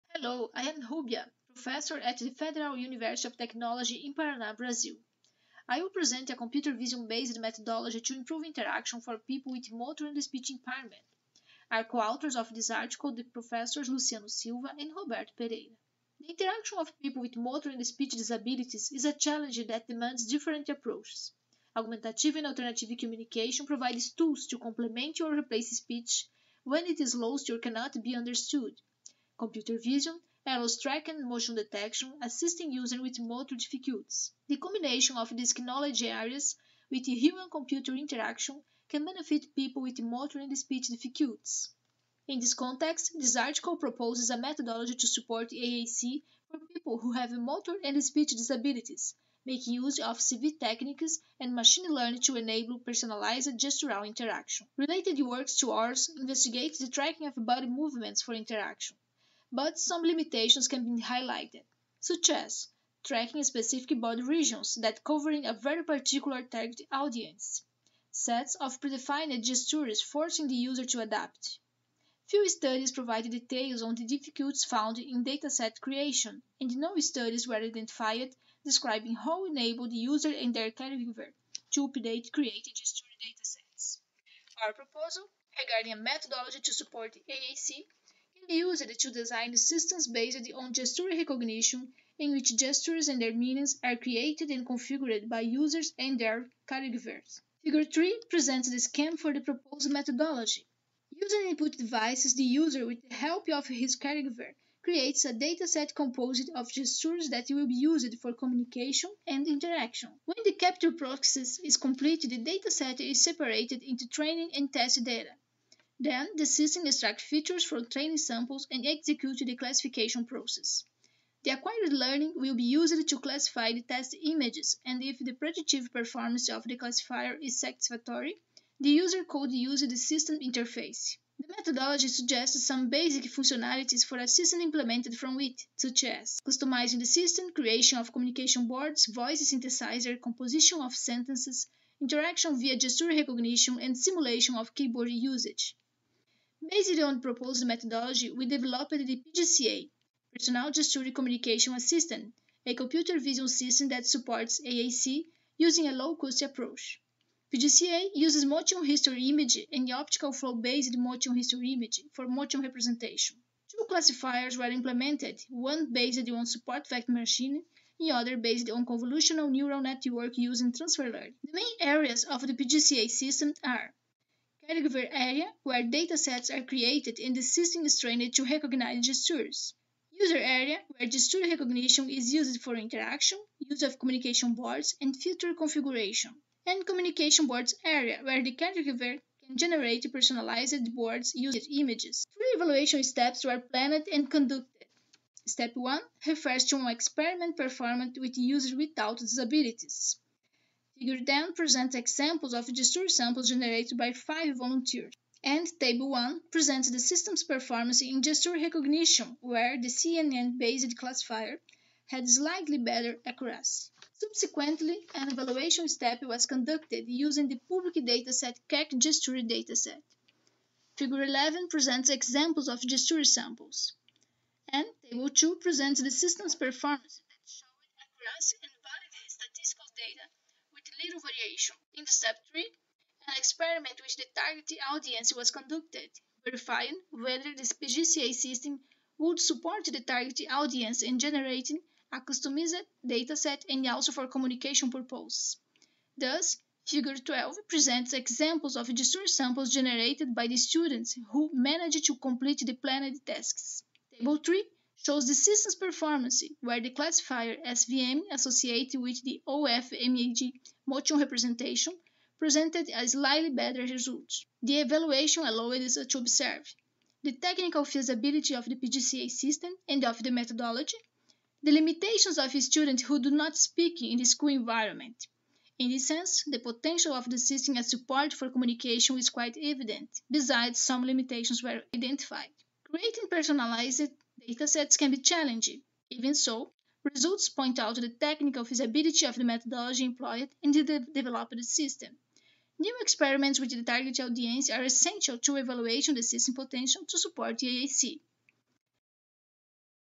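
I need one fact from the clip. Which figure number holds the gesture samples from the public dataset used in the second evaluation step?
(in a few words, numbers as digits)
11.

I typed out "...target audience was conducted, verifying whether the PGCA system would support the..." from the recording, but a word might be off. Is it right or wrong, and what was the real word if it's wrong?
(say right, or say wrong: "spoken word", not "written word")
right.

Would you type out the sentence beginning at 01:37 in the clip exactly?
Figure 3 presents the scheme for the proposed methodology.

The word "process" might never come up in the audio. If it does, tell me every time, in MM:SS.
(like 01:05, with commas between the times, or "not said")
01:50, 02:00.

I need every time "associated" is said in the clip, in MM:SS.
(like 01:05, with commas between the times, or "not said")
04:18.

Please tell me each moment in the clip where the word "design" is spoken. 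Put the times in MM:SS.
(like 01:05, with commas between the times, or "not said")
01:29.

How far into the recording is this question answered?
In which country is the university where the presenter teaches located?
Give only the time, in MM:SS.
00:04.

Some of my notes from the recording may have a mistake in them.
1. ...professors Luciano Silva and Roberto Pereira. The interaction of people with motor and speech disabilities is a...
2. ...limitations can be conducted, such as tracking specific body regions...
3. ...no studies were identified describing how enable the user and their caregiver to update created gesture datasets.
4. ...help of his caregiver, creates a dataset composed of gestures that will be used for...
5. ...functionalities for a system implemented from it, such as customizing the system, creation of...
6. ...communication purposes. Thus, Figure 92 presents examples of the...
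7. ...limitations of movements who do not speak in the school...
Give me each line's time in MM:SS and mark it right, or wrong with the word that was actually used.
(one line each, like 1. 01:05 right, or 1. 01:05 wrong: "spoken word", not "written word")
1. 00:13 right
2. 01:00 wrong: "highlighted", not "conducted"
3. 01:16 right
4. 01:43 right
5. 02:13 right
6. 04:04 wrong: "12", not "92"
7. 04:31 wrong: "students", not "movements".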